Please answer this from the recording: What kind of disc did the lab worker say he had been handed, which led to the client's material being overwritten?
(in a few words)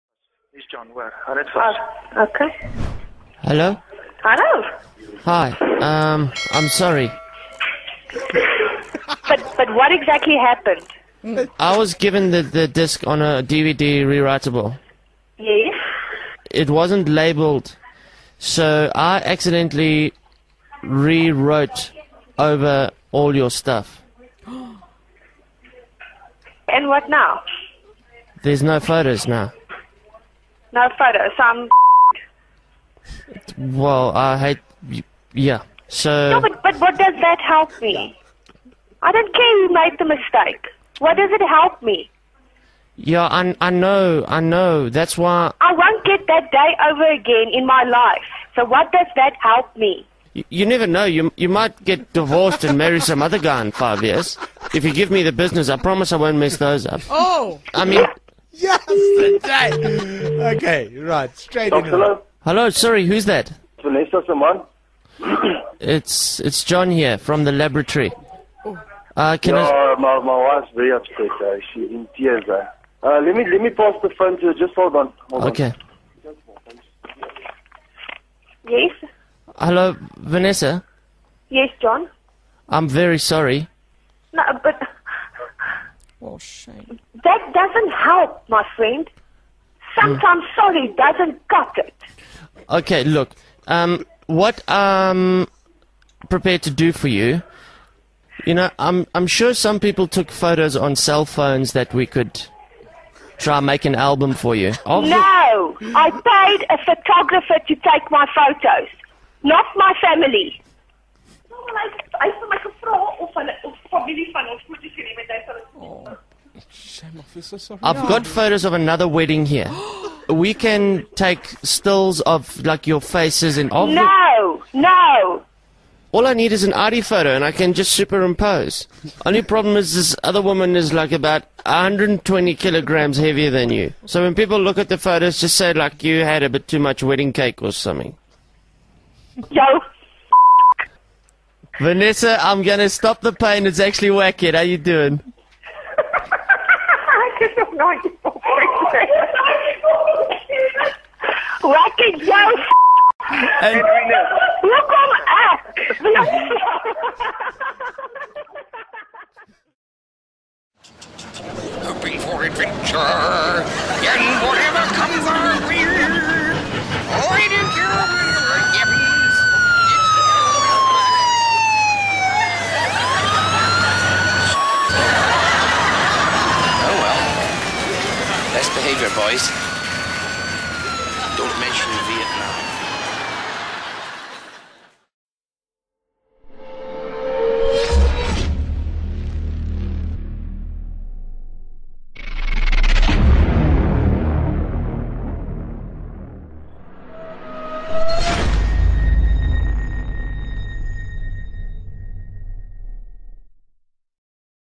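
DVD rewritable.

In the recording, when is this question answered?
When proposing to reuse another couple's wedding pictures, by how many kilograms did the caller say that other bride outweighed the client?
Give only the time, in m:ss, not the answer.
2:11.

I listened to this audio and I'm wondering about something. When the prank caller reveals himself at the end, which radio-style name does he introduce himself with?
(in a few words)
Rocky Joe.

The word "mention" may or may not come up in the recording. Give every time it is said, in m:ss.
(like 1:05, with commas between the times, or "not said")
3:01.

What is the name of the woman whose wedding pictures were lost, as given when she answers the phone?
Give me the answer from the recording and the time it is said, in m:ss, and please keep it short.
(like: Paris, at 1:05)
Vanessa Simon, at 1:03.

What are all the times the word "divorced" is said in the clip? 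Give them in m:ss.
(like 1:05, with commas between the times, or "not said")
0:52.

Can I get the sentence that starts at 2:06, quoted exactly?
All I need is an ID photo, and I can just superimpose.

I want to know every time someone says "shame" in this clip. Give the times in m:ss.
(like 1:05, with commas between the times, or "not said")
1:26, 1:56.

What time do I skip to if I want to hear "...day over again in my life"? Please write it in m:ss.
0:46.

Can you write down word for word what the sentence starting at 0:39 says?
I don't care who made the mistake.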